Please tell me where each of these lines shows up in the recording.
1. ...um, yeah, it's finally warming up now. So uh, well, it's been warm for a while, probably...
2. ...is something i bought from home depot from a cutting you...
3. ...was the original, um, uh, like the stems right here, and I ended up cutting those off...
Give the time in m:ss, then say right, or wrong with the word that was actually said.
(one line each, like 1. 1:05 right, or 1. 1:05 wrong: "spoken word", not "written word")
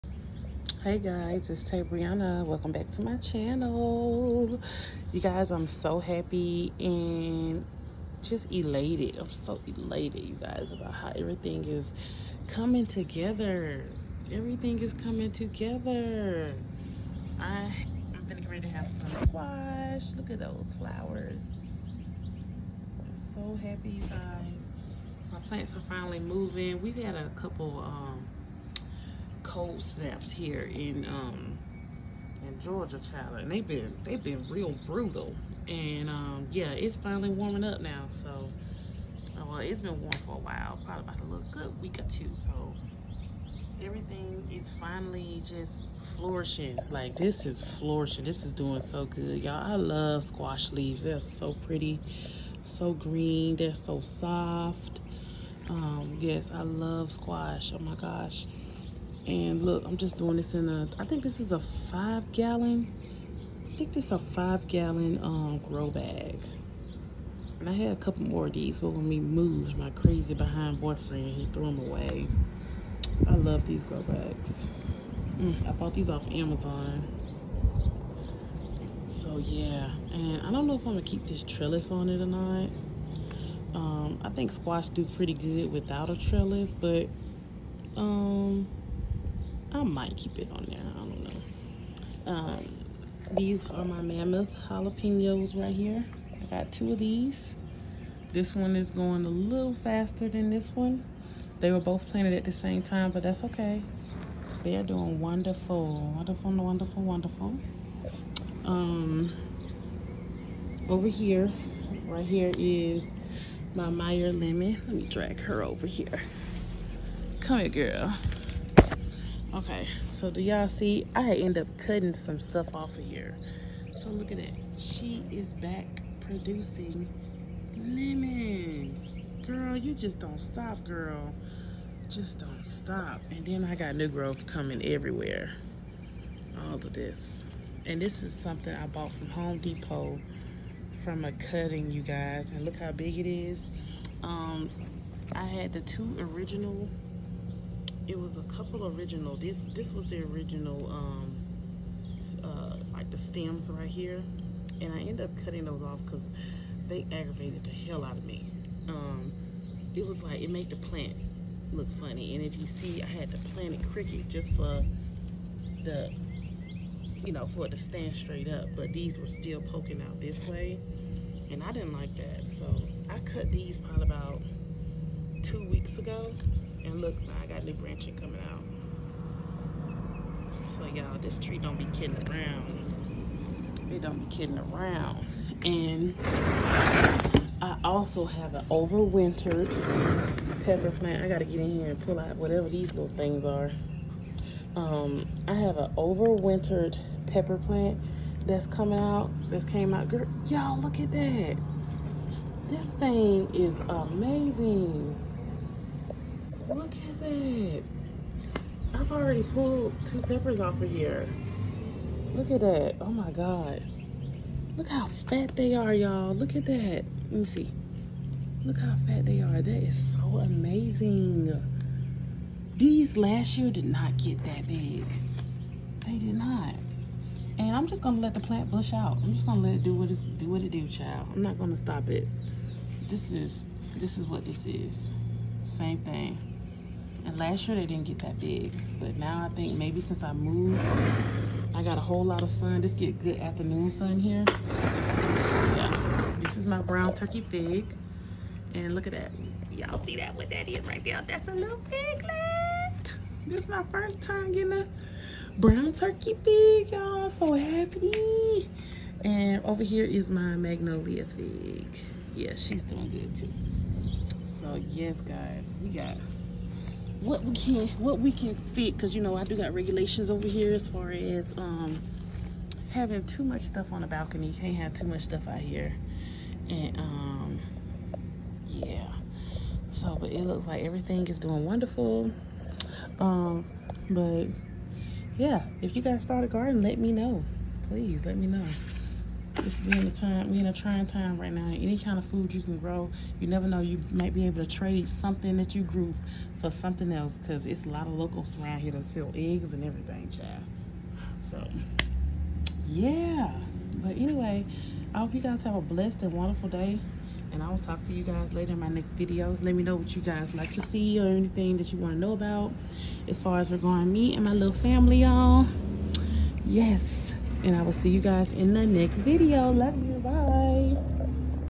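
1. 0:36 right
2. 2:18 right
3. 2:29 right.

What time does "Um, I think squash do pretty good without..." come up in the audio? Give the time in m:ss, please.
1:23.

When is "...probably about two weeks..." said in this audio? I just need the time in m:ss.
2:53.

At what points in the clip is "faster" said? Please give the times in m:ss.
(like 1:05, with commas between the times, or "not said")
1:39.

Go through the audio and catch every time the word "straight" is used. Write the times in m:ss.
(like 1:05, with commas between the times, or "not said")
2:48.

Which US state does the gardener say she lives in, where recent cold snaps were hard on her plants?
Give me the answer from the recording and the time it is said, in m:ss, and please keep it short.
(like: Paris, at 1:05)
Georgia, at 0:32.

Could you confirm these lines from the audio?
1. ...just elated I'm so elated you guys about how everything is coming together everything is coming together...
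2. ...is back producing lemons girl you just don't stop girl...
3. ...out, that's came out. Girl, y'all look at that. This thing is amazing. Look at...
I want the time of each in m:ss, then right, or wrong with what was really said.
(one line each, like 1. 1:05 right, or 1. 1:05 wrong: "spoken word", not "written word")
1. 0:08 right
2. 2:05 right
3. 3:18 right.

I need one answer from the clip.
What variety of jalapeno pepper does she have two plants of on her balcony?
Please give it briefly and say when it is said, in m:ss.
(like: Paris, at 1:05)
Mammoth, at 1:34.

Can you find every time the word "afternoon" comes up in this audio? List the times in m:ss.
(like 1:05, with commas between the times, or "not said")
4:03.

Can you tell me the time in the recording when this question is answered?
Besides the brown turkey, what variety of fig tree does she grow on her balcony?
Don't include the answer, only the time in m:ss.
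4:20.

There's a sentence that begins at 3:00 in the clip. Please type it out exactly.
So y'all, this tree don't be kidding around.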